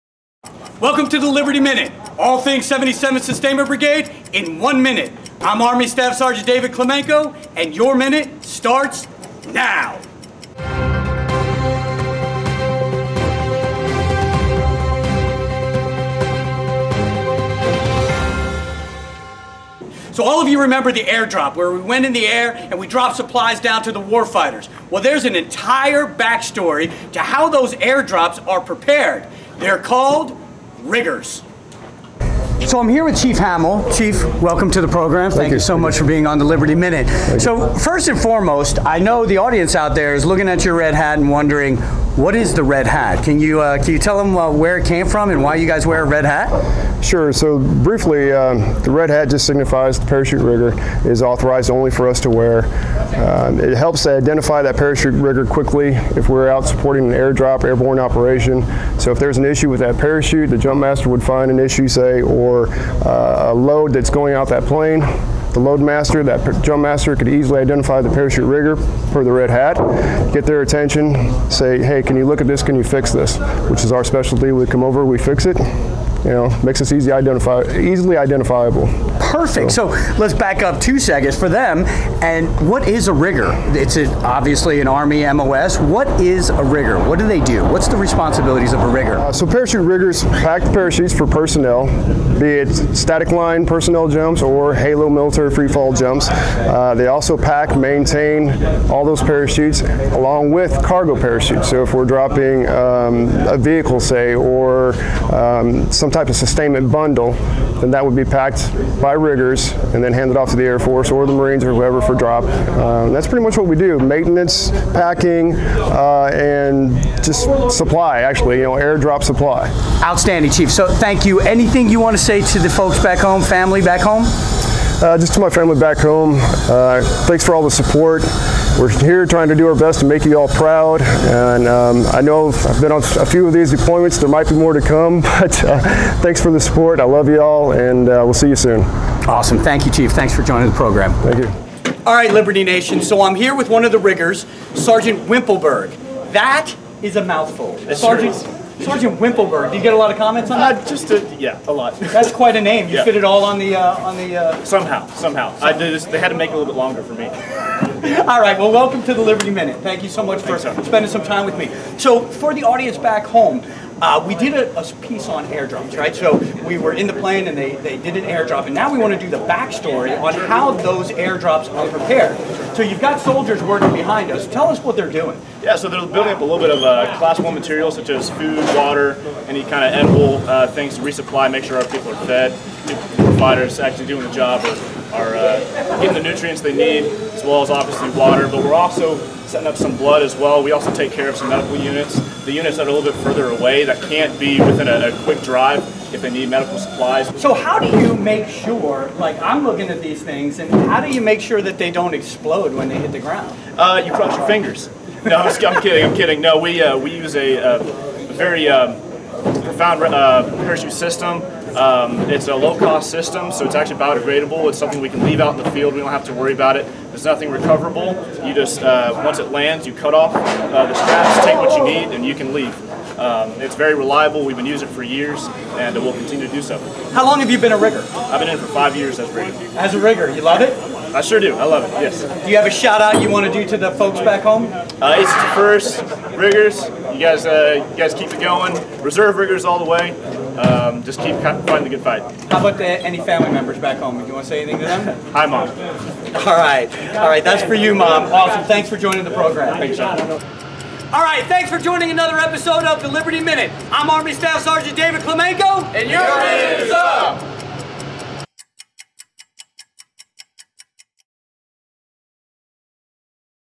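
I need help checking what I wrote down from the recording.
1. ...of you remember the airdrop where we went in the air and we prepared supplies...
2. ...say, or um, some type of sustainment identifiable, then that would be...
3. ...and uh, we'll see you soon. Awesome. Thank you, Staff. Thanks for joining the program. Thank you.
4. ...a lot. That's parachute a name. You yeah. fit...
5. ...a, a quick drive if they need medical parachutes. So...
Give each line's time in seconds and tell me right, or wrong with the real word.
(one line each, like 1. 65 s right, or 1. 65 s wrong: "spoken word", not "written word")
1. 20 s wrong: "dropped", not "prepared"
2. 104 s wrong: "bundle", not "identifiable"
3. 137 s wrong: "Chief", not "Staff"
4. 151 s wrong: "quite", not "parachute"
5. 194 s wrong: "supplies", not "parachutes".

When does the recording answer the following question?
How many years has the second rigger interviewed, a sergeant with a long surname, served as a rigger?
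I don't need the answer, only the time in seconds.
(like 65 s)
228 s.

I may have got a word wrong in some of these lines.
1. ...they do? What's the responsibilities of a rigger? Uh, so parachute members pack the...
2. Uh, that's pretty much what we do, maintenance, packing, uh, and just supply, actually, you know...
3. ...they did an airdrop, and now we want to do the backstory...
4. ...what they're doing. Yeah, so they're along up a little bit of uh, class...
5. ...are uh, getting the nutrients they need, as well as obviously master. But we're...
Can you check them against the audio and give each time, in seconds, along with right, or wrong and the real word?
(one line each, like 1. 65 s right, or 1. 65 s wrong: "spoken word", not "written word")
1. 87 s wrong: "riggers", not "members"
2. 112 s right
3. 167 s right
4. 174 s wrong: "building", not "along"
5. 185 s wrong: "water", not "master".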